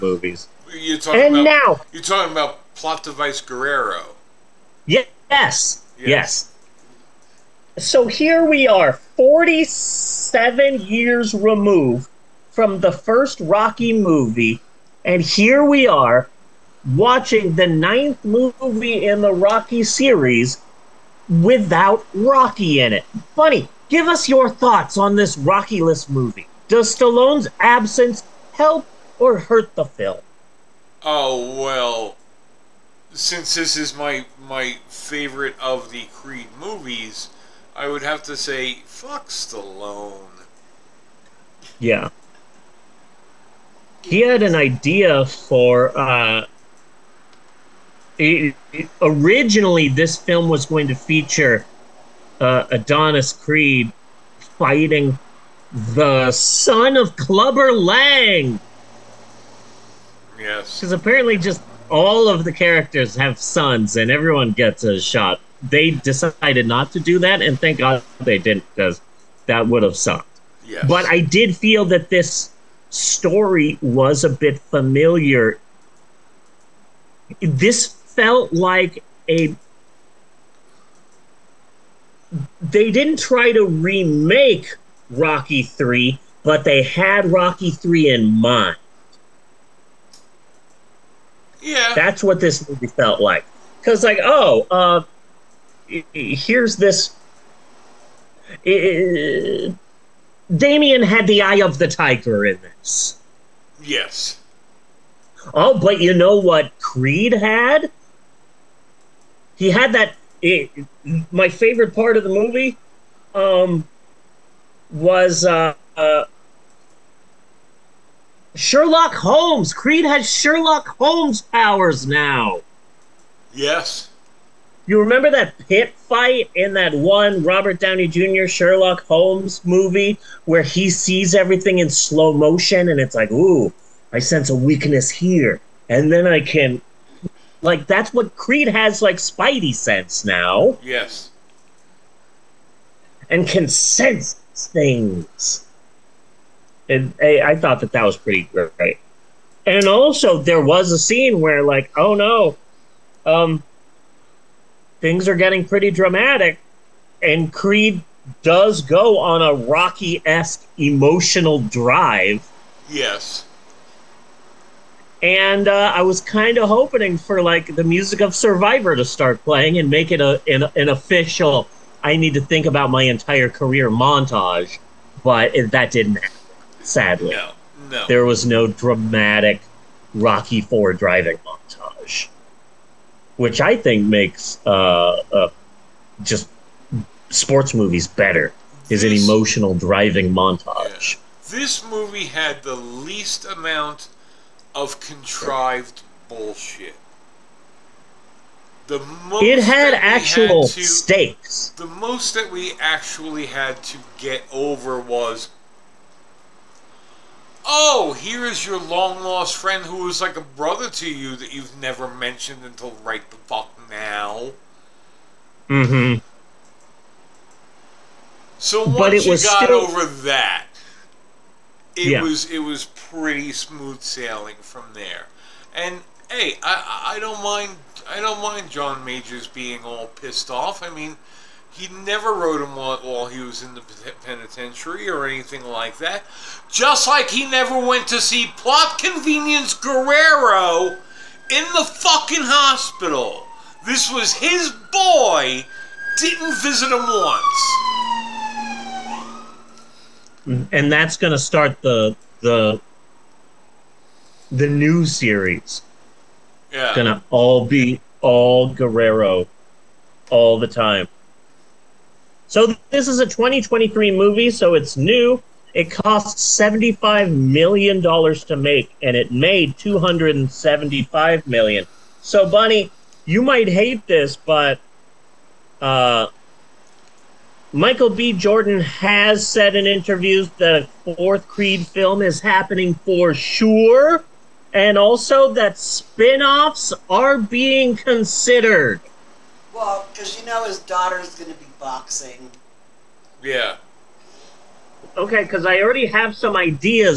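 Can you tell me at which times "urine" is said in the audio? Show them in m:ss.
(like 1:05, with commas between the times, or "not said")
not said.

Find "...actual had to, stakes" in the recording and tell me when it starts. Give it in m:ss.
3:19.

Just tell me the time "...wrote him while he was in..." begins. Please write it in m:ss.
3:52.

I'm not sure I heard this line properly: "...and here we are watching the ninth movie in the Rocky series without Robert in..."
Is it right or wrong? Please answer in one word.
wrong.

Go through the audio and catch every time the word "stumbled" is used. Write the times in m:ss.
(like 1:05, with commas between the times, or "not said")
not said.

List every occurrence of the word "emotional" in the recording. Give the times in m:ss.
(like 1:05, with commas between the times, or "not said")
2:40, 3:09.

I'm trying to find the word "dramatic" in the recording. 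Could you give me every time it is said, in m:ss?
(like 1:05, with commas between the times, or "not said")
2:35, 2:58.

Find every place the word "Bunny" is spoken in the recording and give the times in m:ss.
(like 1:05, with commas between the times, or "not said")
4:32.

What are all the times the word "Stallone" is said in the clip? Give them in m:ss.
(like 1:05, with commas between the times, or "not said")
0:26, 0:39.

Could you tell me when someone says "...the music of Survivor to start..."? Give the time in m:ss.
2:47.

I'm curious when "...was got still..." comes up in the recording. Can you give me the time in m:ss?
3:39.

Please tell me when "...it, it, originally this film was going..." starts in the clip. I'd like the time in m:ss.
0:48.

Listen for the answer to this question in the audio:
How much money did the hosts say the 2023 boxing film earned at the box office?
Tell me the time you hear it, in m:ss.
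4:29.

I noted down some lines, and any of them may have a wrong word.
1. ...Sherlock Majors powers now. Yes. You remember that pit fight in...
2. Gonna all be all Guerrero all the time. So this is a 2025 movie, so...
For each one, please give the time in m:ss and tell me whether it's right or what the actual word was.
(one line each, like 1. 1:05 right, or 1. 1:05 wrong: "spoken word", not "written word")
1. 2:00 wrong: "Holmes", not "Majors"
2. 4:16 wrong: "2023", not "2025".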